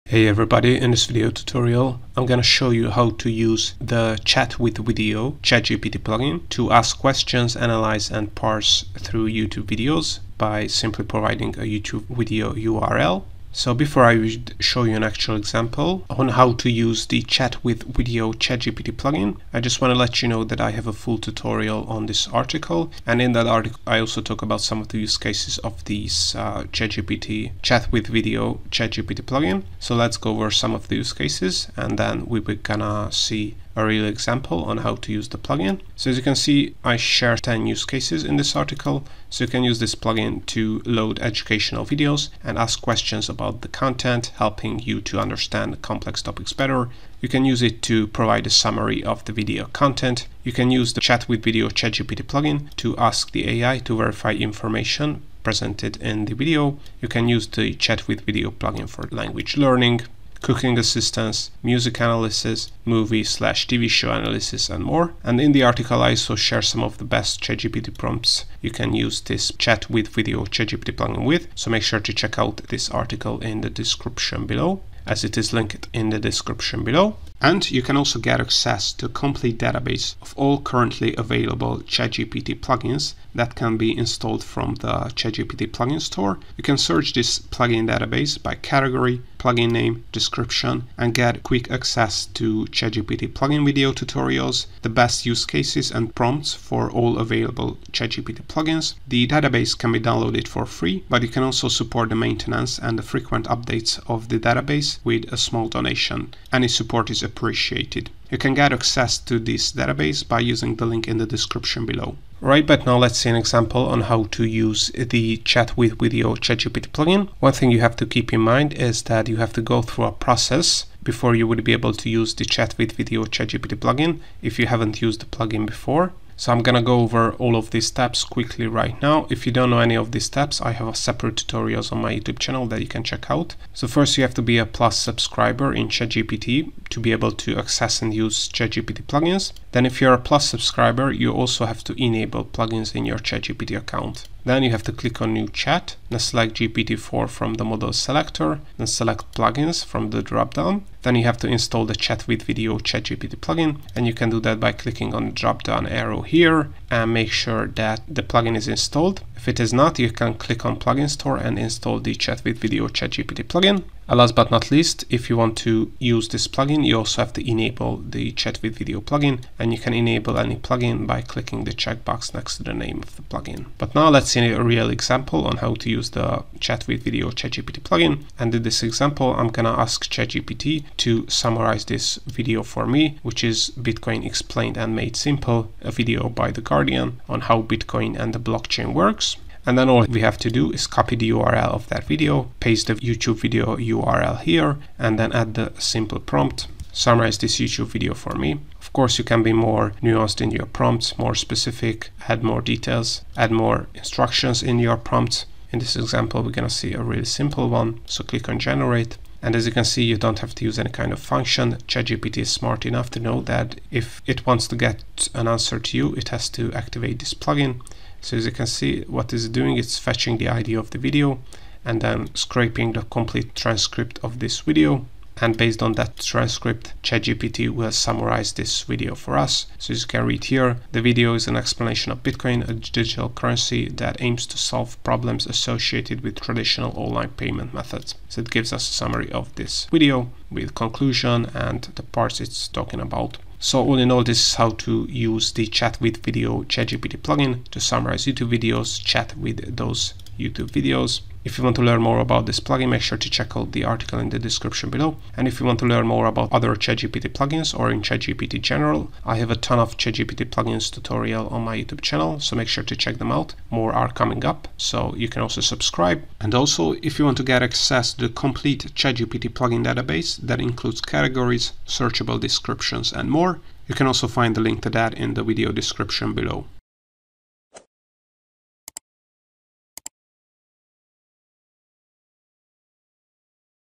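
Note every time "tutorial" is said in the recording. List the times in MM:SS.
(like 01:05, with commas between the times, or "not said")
00:01, 00:21, 01:33, 02:11, 04:20.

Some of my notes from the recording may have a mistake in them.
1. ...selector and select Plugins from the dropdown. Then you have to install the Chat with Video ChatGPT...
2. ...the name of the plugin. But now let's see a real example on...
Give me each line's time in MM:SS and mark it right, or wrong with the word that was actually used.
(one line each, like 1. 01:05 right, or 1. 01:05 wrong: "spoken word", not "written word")
1. 02:27 right
2. 02:52 right.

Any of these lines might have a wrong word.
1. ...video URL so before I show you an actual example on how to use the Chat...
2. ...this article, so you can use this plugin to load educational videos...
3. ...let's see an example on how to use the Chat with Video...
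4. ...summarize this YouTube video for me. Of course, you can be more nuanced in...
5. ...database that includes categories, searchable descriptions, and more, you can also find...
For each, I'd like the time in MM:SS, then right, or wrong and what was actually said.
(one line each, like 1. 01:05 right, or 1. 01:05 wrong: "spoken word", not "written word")
1. 00:12 right
2. 00:38 right
3. 01:52 right
4. 03:16 right
5. 04:29 right.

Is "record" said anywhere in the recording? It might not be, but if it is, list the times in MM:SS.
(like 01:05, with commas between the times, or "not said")
not said.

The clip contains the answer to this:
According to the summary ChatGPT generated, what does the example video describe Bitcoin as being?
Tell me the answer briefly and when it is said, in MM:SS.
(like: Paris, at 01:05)
a digital currency, at 03:52.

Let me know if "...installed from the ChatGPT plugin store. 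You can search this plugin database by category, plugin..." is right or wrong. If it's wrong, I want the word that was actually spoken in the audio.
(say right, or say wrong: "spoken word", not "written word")
right.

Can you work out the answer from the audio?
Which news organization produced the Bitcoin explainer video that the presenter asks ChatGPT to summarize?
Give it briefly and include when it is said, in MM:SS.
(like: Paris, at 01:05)
The Guardian, at 03:06.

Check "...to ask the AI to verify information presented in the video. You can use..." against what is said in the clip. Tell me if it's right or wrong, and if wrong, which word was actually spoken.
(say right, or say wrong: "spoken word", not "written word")
right.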